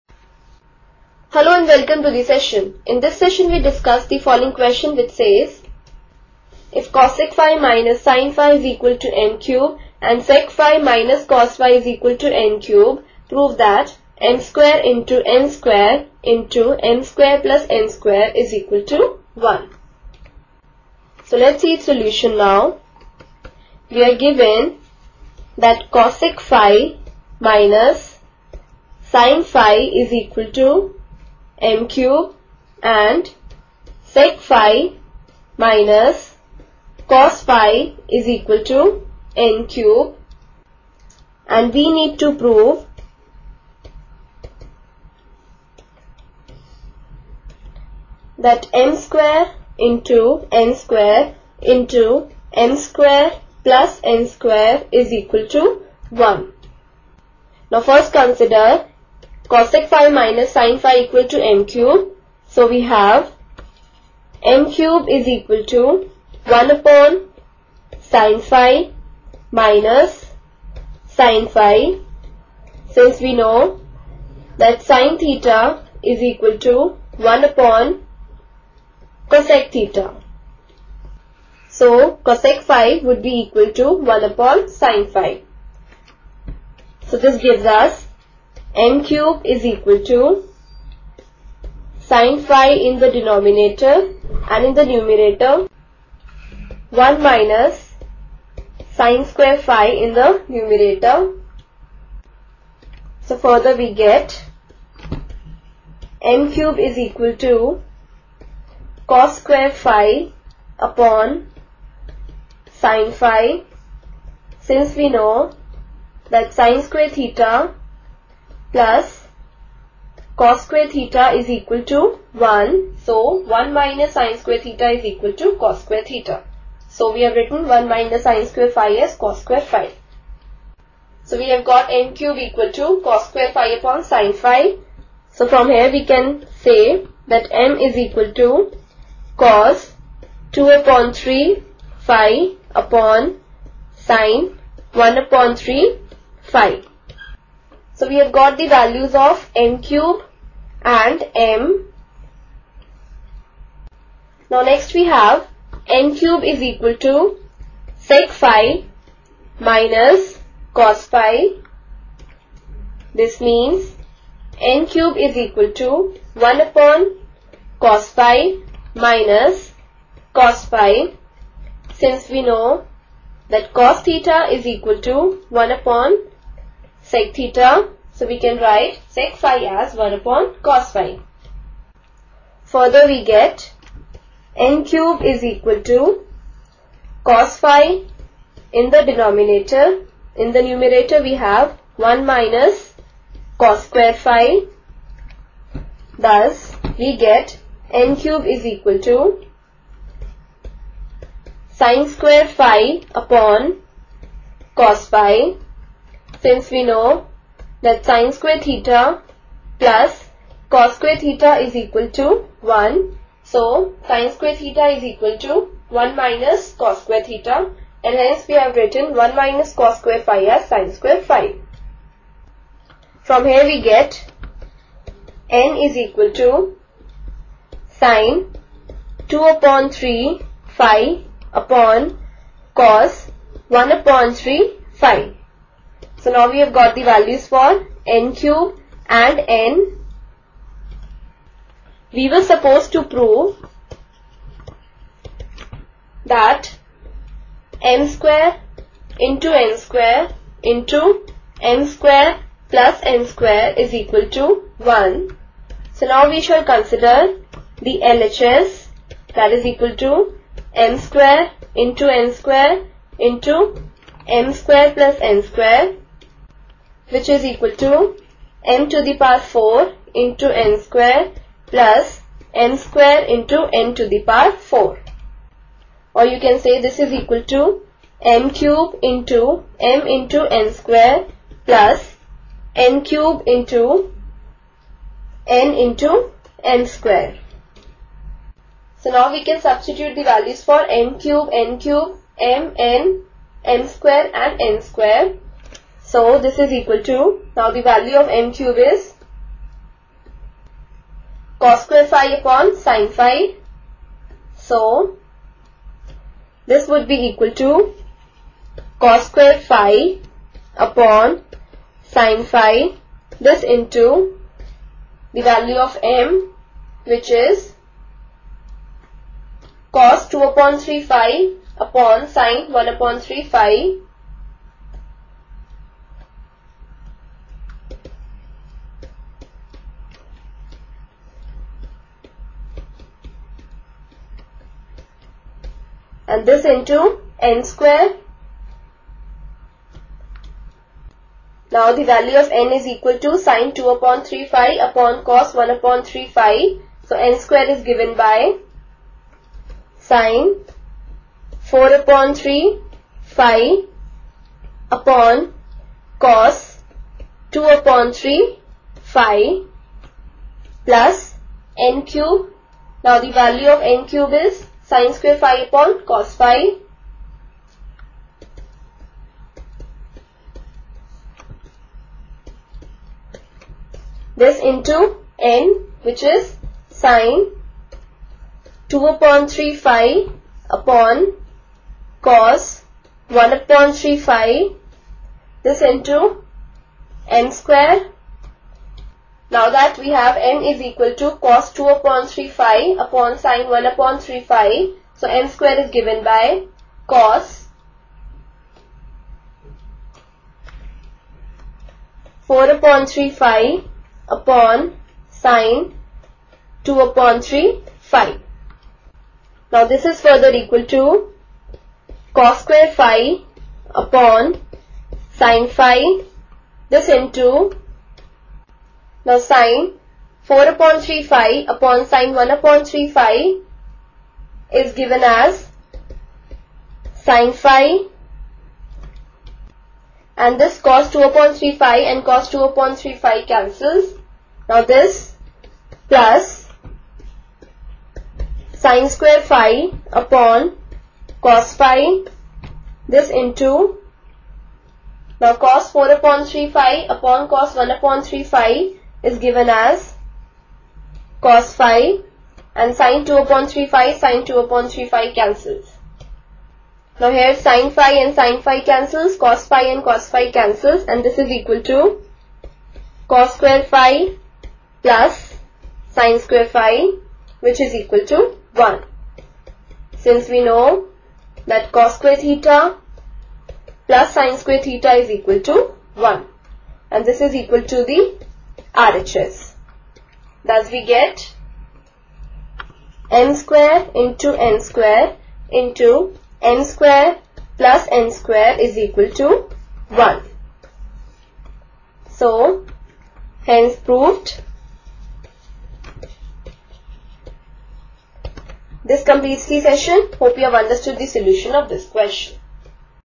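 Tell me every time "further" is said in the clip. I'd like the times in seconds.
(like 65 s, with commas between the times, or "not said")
103 s, 182 s, 410 s.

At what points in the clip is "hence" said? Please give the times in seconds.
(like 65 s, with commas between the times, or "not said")
218 s, 493 s.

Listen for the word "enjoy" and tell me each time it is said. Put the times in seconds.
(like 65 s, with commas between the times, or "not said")
not said.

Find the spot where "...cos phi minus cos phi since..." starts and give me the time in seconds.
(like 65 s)
167 s.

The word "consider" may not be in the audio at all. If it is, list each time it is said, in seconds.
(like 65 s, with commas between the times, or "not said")
58 s, 256 s.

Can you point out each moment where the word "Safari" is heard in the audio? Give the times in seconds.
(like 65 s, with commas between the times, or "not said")
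not said.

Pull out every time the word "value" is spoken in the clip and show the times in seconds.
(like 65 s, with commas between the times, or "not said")
148 s, 237 s, 290 s, 297 s, 315 s, 342 s, 363 s.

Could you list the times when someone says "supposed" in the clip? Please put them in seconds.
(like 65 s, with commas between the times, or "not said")
242 s.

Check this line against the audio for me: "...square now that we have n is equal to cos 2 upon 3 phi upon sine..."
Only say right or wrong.
right.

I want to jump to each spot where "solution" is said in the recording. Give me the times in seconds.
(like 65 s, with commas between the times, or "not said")
21 s, 501 s.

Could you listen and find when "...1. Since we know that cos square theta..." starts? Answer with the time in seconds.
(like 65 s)
468 s.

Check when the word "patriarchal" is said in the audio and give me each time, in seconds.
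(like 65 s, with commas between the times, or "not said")
not said.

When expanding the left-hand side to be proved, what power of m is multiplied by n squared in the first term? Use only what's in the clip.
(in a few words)
4.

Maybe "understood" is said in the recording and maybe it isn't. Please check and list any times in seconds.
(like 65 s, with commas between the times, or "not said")
500 s.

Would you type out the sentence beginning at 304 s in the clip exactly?
So this would be equal to cos square phi upon sine phi.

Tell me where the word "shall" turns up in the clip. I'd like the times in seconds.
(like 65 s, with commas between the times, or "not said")
256 s.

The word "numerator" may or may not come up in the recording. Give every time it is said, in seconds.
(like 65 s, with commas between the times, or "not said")
94 s, 100 s, 190 s.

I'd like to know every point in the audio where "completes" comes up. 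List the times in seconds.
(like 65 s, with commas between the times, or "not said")
499 s.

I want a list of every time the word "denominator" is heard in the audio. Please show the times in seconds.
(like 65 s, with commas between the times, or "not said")
93 s, 189 s.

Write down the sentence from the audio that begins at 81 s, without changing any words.
So cosec phi would be equal to 1 upon sin phi.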